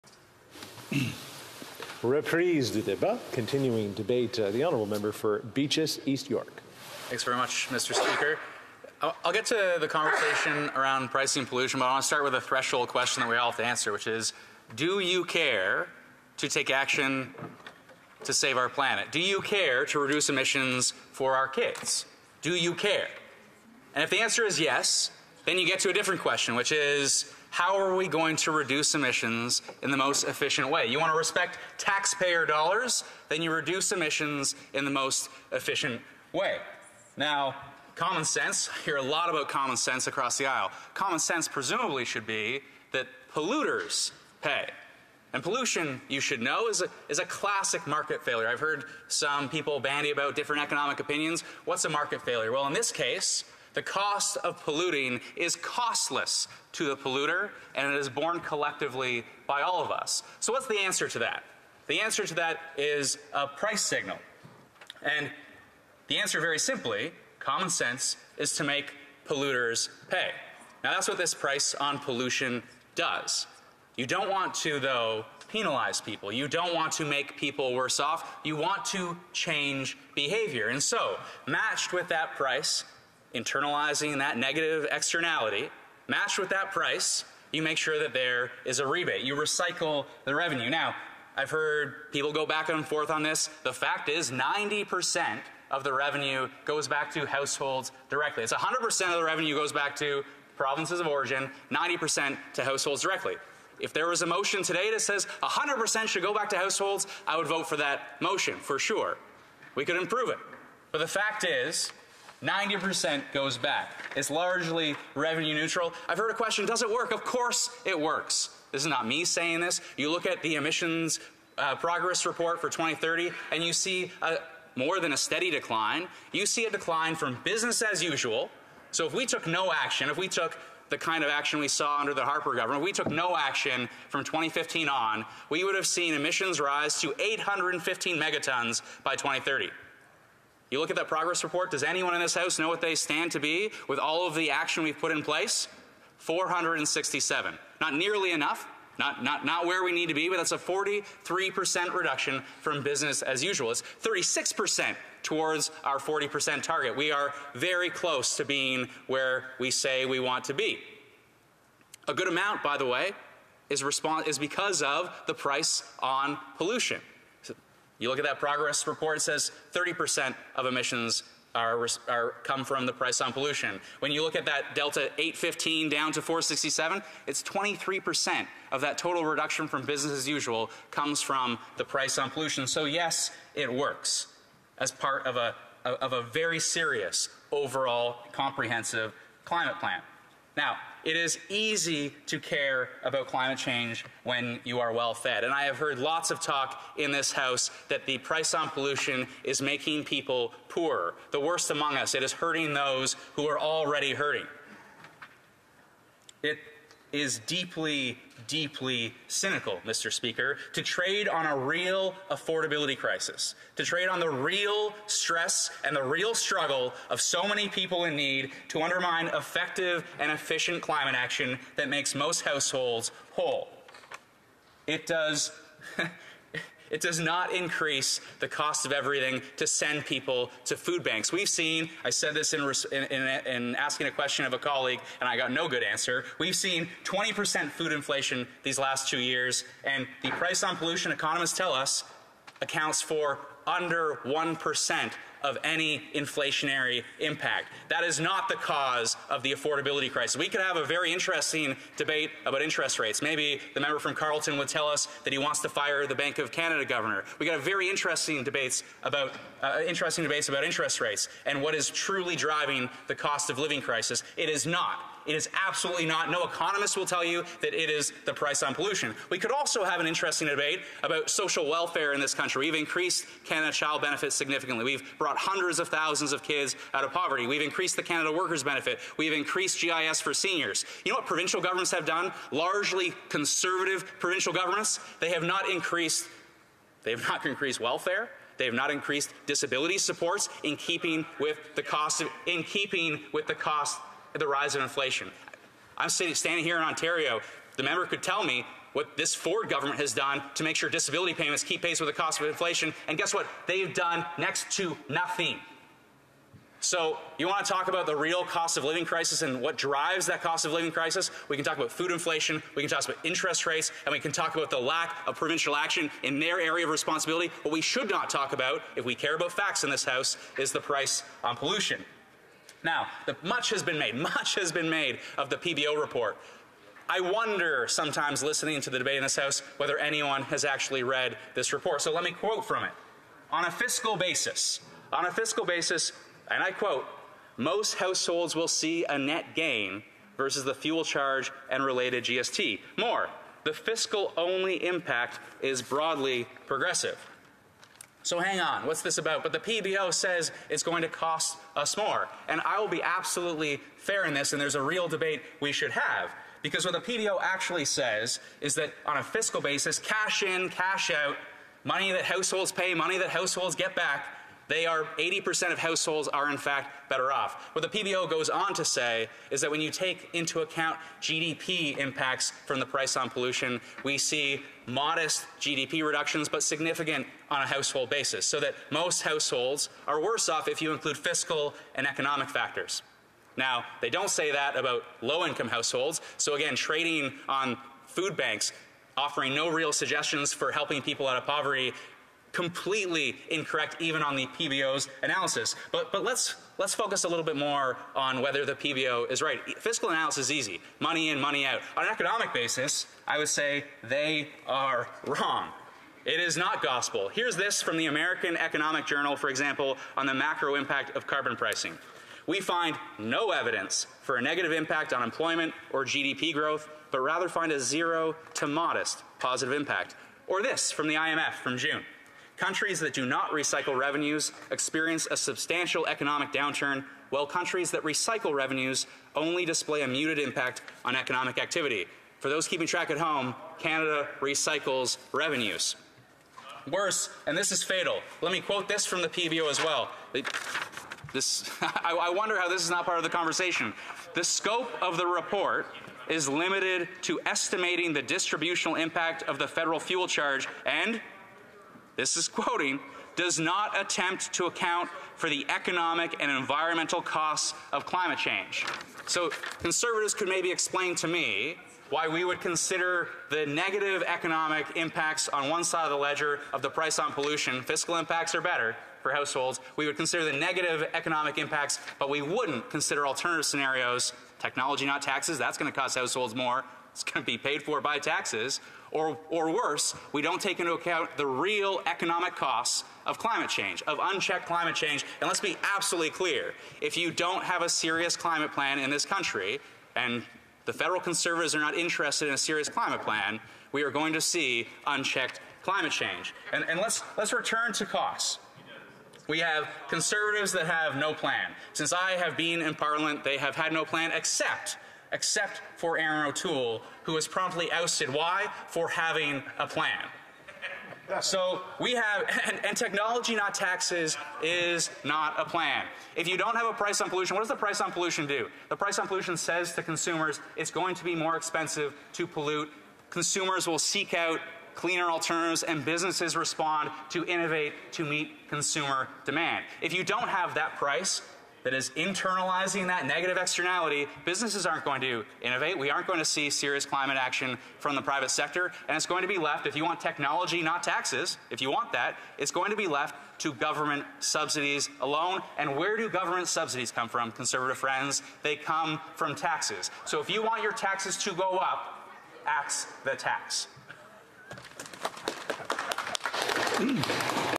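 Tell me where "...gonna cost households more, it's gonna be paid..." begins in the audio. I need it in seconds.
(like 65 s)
475 s.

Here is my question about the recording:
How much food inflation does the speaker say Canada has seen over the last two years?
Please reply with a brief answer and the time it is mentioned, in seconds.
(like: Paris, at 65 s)
20%, at 237 s.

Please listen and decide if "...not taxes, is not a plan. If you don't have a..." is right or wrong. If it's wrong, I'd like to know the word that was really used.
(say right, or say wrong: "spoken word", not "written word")
right.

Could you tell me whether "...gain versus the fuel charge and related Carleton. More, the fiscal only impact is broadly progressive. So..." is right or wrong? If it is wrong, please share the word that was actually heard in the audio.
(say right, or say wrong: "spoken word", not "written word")
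wrong: "GST", not "Carleton".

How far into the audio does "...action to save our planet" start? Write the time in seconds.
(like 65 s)
16 s.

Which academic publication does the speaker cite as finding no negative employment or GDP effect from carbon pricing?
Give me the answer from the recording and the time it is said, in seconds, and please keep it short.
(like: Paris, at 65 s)
American Economic Journal, at 408 s.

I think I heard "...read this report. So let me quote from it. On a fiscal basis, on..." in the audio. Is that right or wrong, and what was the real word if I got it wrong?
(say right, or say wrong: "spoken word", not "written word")
right.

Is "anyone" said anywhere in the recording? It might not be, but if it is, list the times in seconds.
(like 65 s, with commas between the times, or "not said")
141 s, 329 s.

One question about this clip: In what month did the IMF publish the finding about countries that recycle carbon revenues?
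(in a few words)
June.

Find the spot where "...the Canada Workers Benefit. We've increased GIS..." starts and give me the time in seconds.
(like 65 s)
277 s.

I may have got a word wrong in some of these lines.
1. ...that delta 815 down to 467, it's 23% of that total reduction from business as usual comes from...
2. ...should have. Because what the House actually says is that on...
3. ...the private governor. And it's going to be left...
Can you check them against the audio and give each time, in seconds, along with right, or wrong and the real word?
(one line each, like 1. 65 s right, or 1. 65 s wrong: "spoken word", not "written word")
1. 174 s right
2. 355 s wrong: "PBO", not "House"
3. 538 s wrong: "sector", not "governor".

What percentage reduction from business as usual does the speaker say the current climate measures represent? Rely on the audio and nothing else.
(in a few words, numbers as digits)
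43%.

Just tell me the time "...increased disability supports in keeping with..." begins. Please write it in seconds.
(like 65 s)
288 s.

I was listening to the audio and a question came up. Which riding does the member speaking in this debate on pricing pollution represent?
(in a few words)
Beaches, East York.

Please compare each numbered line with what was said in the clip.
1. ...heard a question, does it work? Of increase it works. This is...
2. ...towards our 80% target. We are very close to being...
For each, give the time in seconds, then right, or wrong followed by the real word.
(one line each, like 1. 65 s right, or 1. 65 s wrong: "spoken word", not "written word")
1. 116 s wrong: "course", not "increase"
2. 155 s wrong: "40", not "80".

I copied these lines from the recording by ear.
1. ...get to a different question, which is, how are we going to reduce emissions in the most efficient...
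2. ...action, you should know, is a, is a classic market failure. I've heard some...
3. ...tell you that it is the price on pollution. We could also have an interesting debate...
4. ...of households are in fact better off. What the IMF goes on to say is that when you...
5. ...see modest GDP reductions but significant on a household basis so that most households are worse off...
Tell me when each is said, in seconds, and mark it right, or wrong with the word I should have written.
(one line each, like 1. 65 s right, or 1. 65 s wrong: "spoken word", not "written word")
1. 25 s right
2. 45 s wrong: "pollution", not "action"
3. 267 s right
4. 365 s wrong: "PBO", not "IMF"
5. 374 s right.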